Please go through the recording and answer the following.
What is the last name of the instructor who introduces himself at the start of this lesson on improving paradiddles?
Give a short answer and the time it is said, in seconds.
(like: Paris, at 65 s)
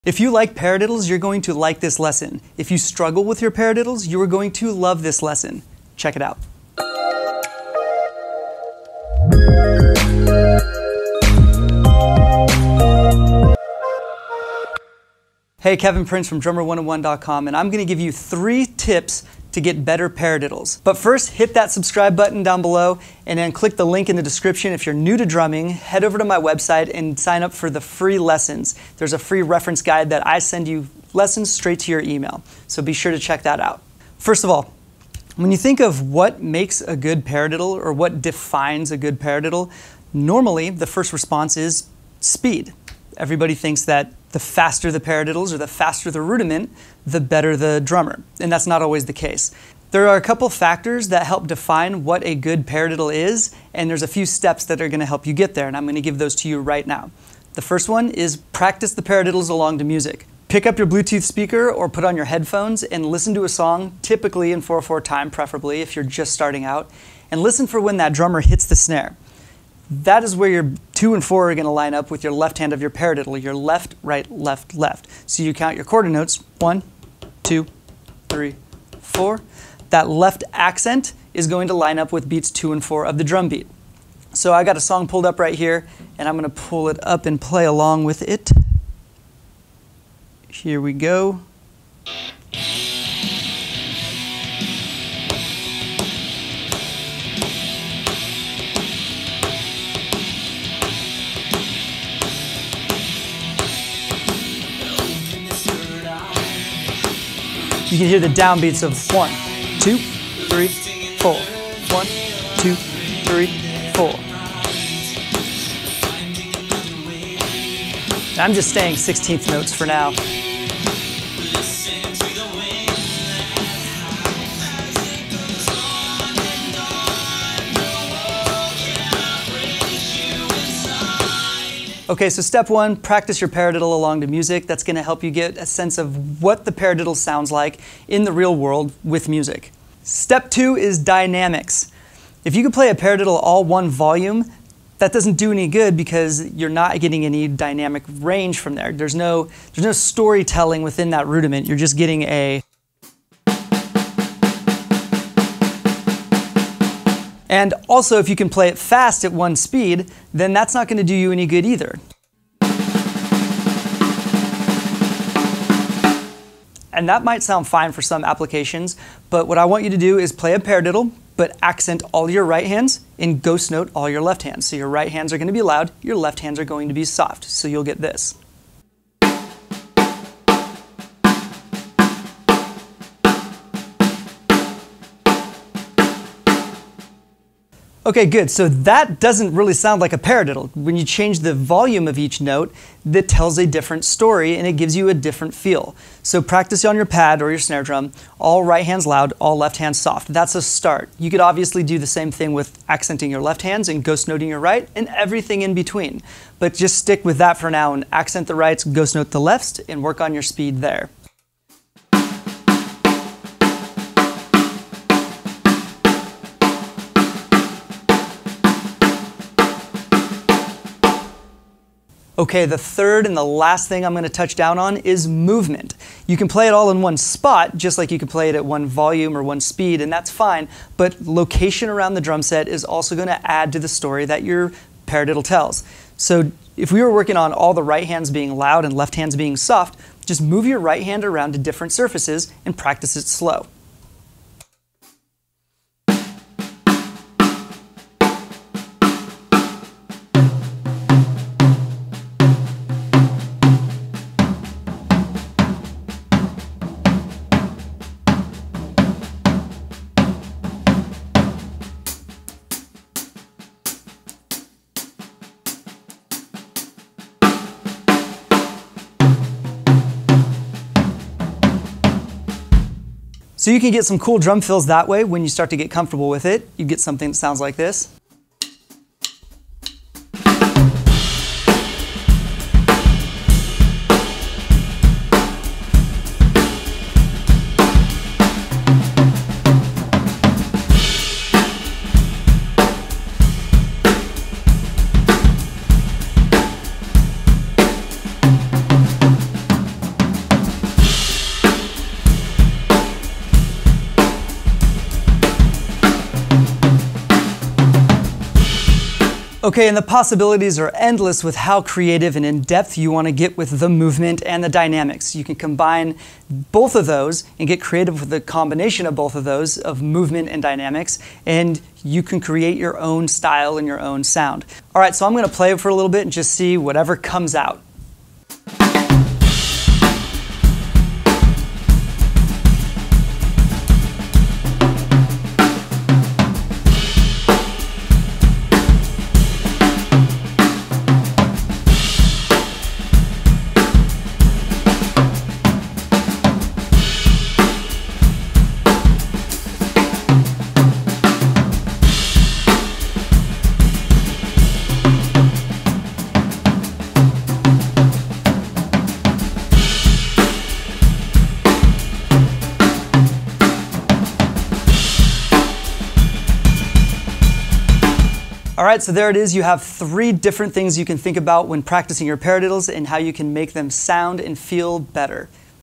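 Prince, at 16 s.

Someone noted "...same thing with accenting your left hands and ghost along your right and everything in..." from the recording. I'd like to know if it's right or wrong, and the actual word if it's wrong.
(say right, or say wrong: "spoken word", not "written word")
wrong: "noting", not "along".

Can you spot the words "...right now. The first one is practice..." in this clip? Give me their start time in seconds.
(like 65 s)
56 s.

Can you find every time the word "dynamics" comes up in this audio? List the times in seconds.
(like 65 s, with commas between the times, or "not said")
140 s, 147 s, 314 s, 320 s.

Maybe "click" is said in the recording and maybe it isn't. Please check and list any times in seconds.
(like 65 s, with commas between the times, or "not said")
23 s.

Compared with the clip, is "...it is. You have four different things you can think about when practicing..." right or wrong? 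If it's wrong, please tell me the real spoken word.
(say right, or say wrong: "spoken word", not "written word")
wrong: "three", not "four".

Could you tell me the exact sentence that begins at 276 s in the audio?
You get something that sounds like this.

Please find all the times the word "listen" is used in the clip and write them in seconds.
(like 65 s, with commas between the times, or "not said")
63 s, 67 s.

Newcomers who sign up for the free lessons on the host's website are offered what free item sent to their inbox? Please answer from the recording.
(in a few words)
reference guide.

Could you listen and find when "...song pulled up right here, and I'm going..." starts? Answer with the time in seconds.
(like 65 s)
84 s.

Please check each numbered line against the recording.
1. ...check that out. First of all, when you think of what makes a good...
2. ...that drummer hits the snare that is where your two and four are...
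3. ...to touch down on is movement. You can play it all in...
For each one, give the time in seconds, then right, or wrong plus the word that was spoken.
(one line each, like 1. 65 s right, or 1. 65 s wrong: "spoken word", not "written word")
1. 33 s right
2. 67 s right
3. 224 s right.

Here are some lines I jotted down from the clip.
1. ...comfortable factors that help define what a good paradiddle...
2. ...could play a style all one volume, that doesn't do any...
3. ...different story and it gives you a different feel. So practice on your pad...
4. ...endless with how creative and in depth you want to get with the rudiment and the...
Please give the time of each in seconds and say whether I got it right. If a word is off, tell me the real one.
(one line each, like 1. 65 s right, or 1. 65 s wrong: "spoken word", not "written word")
1. 50 s wrong: "couple", not "comfortable"
2. 142 s wrong: "paradiddle", not "style"
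3. 193 s right
4. 310 s wrong: "movement", not "rudiment".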